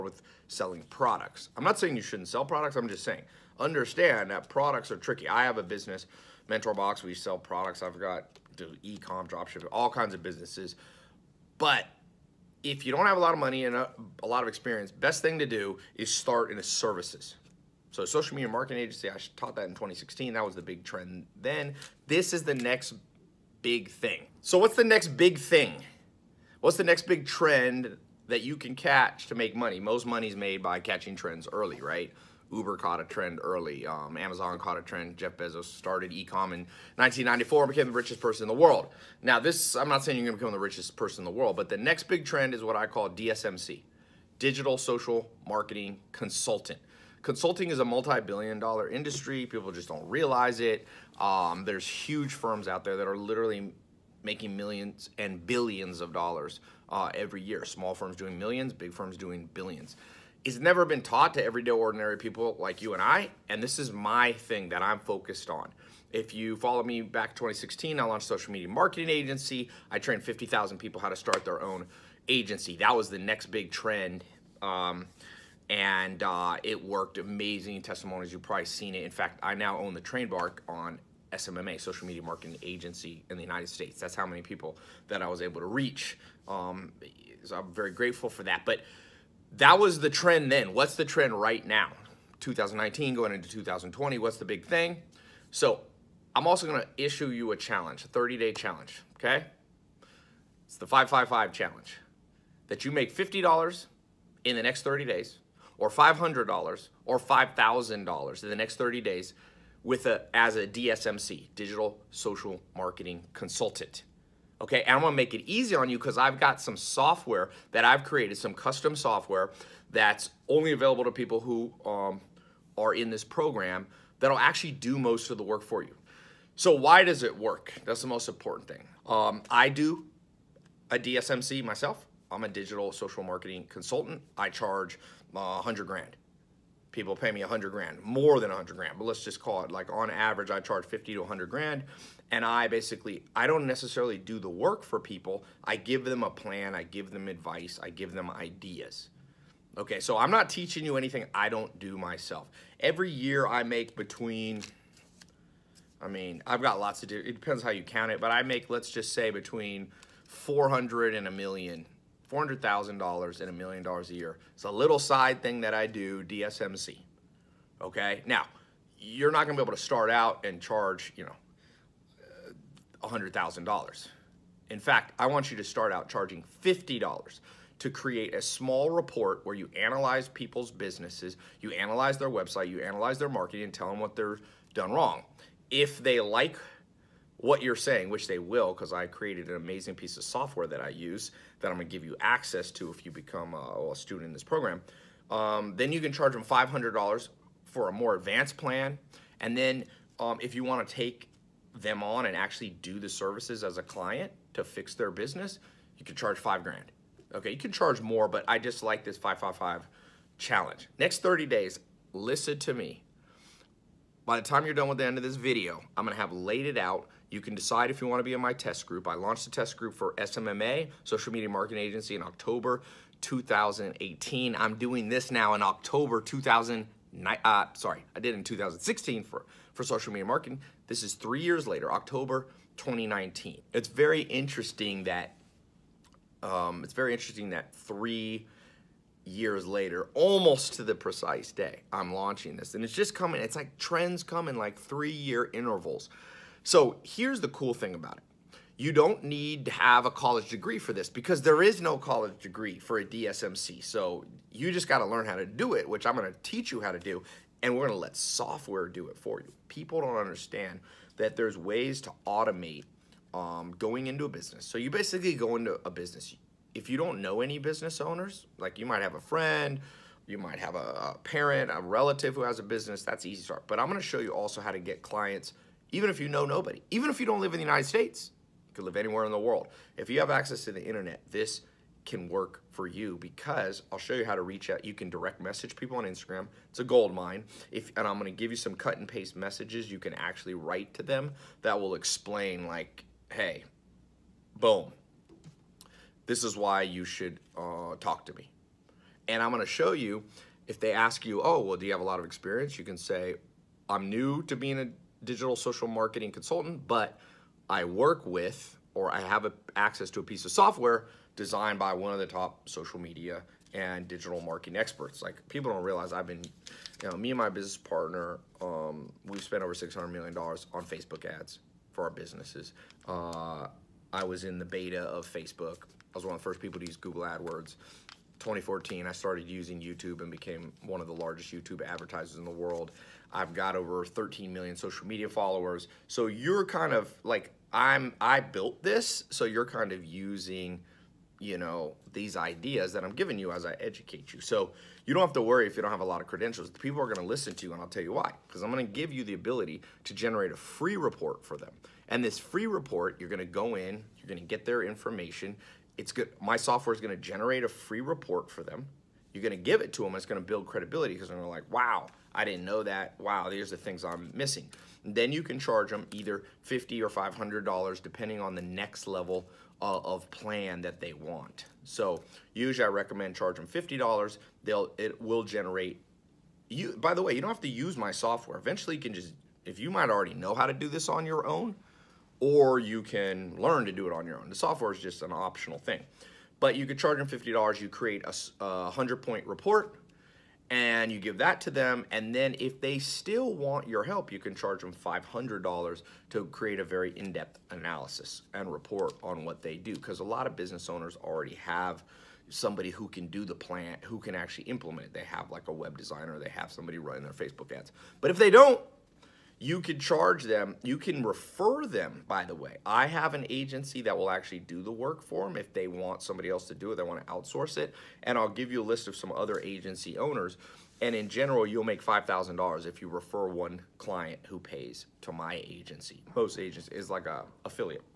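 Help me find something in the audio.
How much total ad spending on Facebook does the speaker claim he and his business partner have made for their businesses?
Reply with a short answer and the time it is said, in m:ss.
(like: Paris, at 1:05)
$600 million, at 5:19.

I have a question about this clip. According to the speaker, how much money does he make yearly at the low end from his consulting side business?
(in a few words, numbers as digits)
$400,000.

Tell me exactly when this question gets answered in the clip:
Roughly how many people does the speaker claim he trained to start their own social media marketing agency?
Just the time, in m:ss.
1:10.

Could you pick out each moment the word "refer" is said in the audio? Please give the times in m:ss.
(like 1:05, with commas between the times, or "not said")
6:51, 7:03.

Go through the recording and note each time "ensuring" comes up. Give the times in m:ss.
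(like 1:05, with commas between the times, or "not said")
not said.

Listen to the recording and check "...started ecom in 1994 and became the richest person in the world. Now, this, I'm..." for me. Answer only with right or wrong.
right.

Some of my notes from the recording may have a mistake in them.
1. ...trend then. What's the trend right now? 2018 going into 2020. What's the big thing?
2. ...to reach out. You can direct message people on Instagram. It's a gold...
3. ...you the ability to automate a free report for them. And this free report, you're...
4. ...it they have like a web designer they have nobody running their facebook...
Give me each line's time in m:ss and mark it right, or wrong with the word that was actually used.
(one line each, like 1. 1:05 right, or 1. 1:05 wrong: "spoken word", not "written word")
1. 1:30 wrong: "2019", not "2018"
2. 4:44 right
3. 5:49 wrong: "generate", not "automate"
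4. 6:45 wrong: "somebody", not "nobody".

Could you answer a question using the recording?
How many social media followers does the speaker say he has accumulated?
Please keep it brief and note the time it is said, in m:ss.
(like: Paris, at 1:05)
13 million, at 5:34.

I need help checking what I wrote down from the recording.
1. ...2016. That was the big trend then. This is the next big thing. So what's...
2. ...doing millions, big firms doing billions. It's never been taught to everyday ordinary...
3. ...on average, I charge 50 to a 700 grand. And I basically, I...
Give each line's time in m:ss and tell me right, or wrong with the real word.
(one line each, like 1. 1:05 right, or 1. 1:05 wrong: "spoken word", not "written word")
1. 0:19 right
2. 0:58 right
3. 2:19 wrong: "100", not "700".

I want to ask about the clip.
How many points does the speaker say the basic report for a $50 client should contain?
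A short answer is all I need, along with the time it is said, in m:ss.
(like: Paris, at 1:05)
100, at 6:28.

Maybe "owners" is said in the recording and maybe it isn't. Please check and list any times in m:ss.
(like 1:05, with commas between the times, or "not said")
4:27, 6:40, 7:00.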